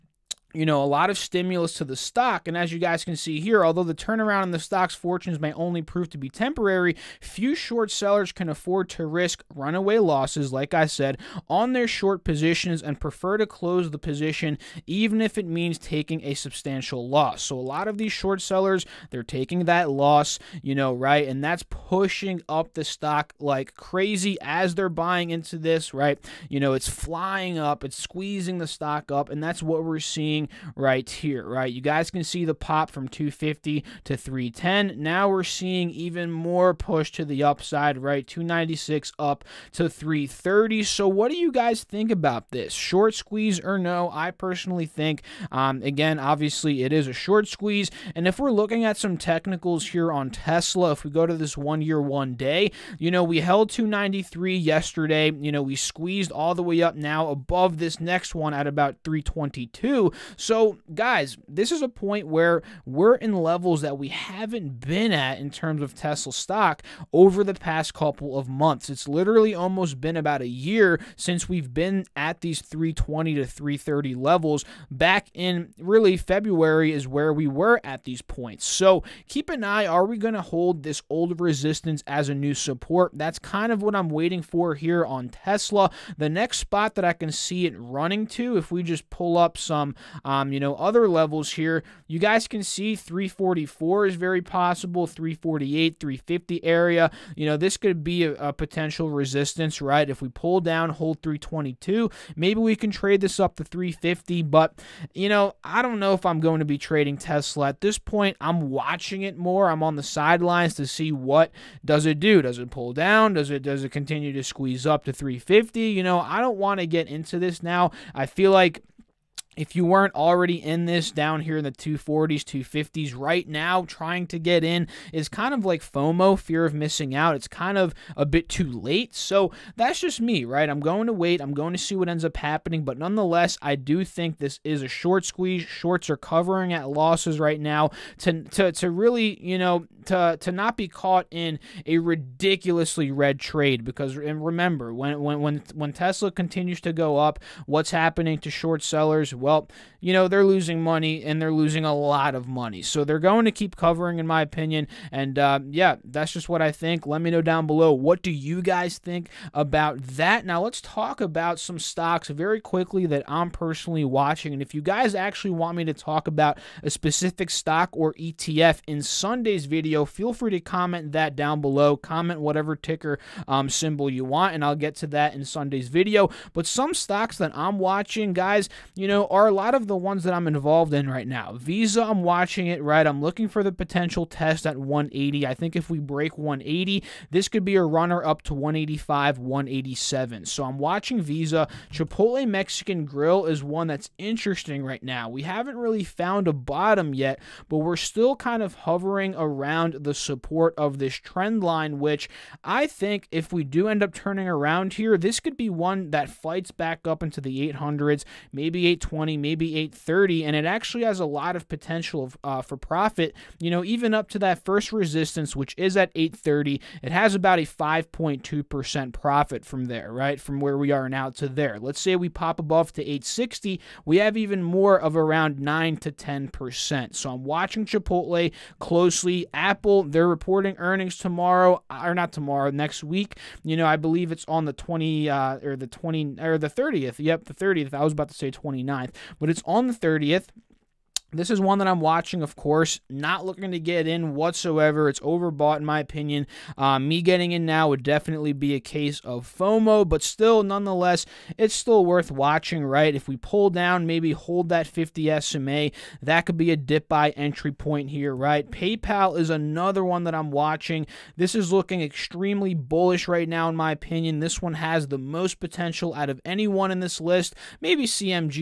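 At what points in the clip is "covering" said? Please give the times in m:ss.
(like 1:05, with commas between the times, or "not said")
2:16, 2:33.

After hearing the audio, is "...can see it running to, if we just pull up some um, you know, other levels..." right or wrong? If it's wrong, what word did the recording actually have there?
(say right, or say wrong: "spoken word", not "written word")
right.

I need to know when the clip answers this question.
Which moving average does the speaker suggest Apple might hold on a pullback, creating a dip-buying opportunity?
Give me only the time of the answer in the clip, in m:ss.
4:14.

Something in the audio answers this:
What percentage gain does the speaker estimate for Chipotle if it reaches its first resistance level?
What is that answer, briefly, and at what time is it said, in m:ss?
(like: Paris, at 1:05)
5.2%, at 3:37.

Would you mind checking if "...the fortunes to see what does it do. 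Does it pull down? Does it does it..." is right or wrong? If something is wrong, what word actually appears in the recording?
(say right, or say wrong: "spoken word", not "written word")
wrong: "sidelines", not "fortunes".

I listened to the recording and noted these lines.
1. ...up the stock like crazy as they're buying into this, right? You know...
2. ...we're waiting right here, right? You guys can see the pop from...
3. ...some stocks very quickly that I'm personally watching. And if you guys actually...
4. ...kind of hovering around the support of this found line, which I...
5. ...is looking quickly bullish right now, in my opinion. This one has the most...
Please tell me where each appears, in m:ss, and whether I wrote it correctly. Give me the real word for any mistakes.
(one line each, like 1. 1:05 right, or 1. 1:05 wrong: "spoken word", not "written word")
1. 0:22 right
2. 0:29 wrong: "seeing", not "waiting"
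3. 2:41 right
4. 3:18 wrong: "trend", not "found"
5. 4:21 wrong: "extremely", not "quickly".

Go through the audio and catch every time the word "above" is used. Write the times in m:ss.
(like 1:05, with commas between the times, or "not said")
0:57, 3:42.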